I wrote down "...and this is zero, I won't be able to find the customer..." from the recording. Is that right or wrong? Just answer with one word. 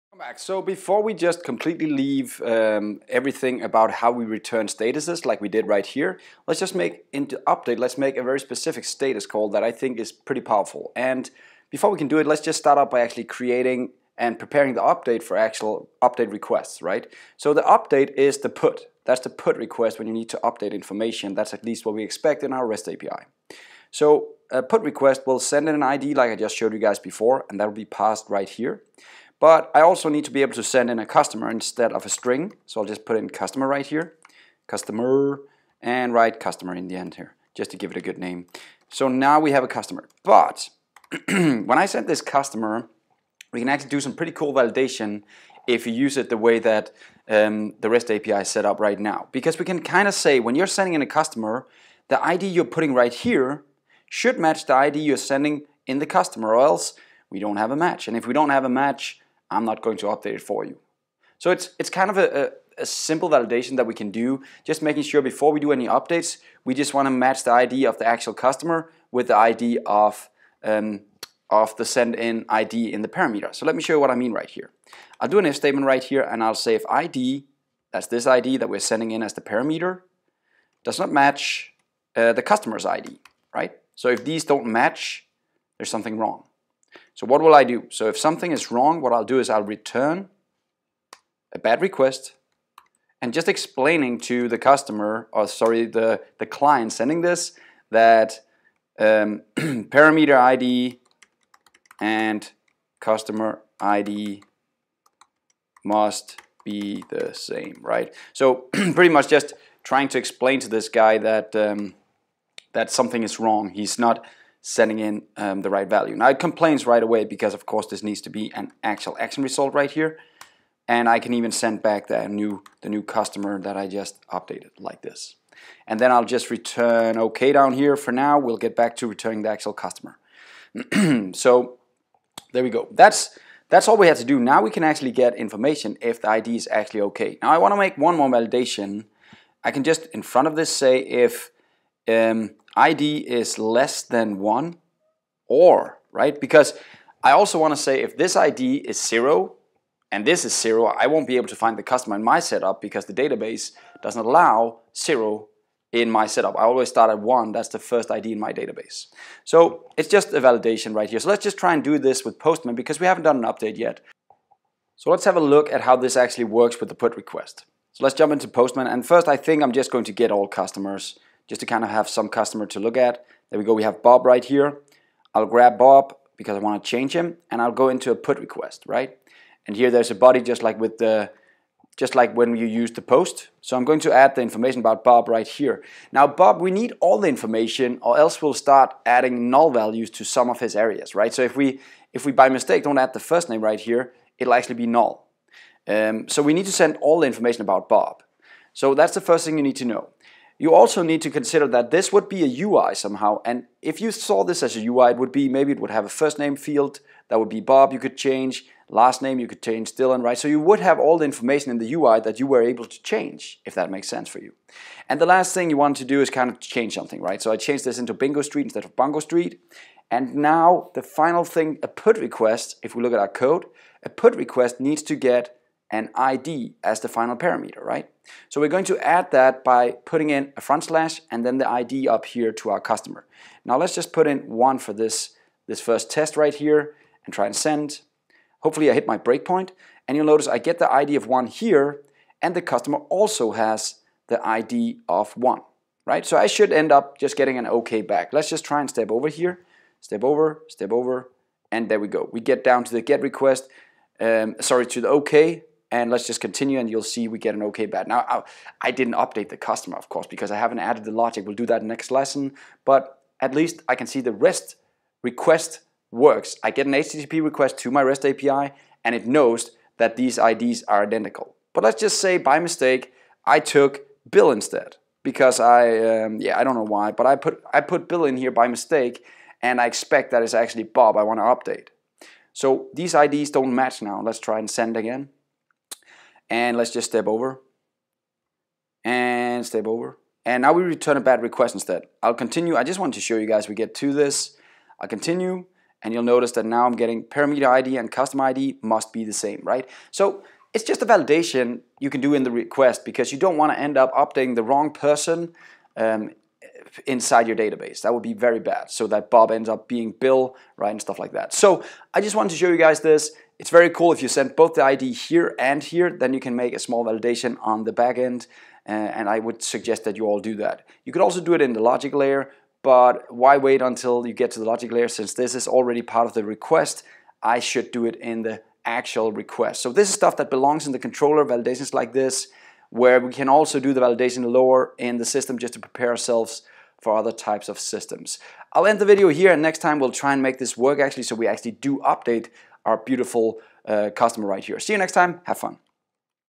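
right.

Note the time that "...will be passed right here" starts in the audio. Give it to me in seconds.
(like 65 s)
27 s.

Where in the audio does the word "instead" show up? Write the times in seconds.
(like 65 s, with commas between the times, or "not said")
31 s, 218 s, 274 s, 291 s.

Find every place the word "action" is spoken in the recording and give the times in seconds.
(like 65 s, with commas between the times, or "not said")
119 s.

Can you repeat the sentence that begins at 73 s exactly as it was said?
So let me show you what I mean right here.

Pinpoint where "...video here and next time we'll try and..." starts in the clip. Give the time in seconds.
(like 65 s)
339 s.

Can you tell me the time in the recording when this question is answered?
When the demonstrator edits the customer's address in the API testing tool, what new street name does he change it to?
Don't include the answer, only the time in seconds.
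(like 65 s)
218 s.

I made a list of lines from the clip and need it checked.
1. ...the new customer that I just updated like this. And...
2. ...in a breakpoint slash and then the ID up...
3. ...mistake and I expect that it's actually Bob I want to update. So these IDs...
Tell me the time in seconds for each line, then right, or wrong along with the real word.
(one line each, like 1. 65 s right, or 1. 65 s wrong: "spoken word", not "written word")
1. 122 s right
2. 230 s wrong: "front", not "breakpoint"
3. 278 s right.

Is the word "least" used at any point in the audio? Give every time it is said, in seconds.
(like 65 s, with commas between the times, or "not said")
21 s, 263 s.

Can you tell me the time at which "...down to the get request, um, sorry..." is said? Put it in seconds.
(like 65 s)
252 s.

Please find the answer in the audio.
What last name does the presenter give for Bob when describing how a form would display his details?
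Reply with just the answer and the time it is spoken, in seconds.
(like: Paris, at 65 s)
Dylan, at 209 s.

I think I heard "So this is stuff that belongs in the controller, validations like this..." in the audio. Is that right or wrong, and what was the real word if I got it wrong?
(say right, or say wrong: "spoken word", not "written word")
right.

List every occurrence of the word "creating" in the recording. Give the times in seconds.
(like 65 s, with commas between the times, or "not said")
13 s.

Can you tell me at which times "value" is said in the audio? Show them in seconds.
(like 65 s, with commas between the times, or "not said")
115 s, 189 s.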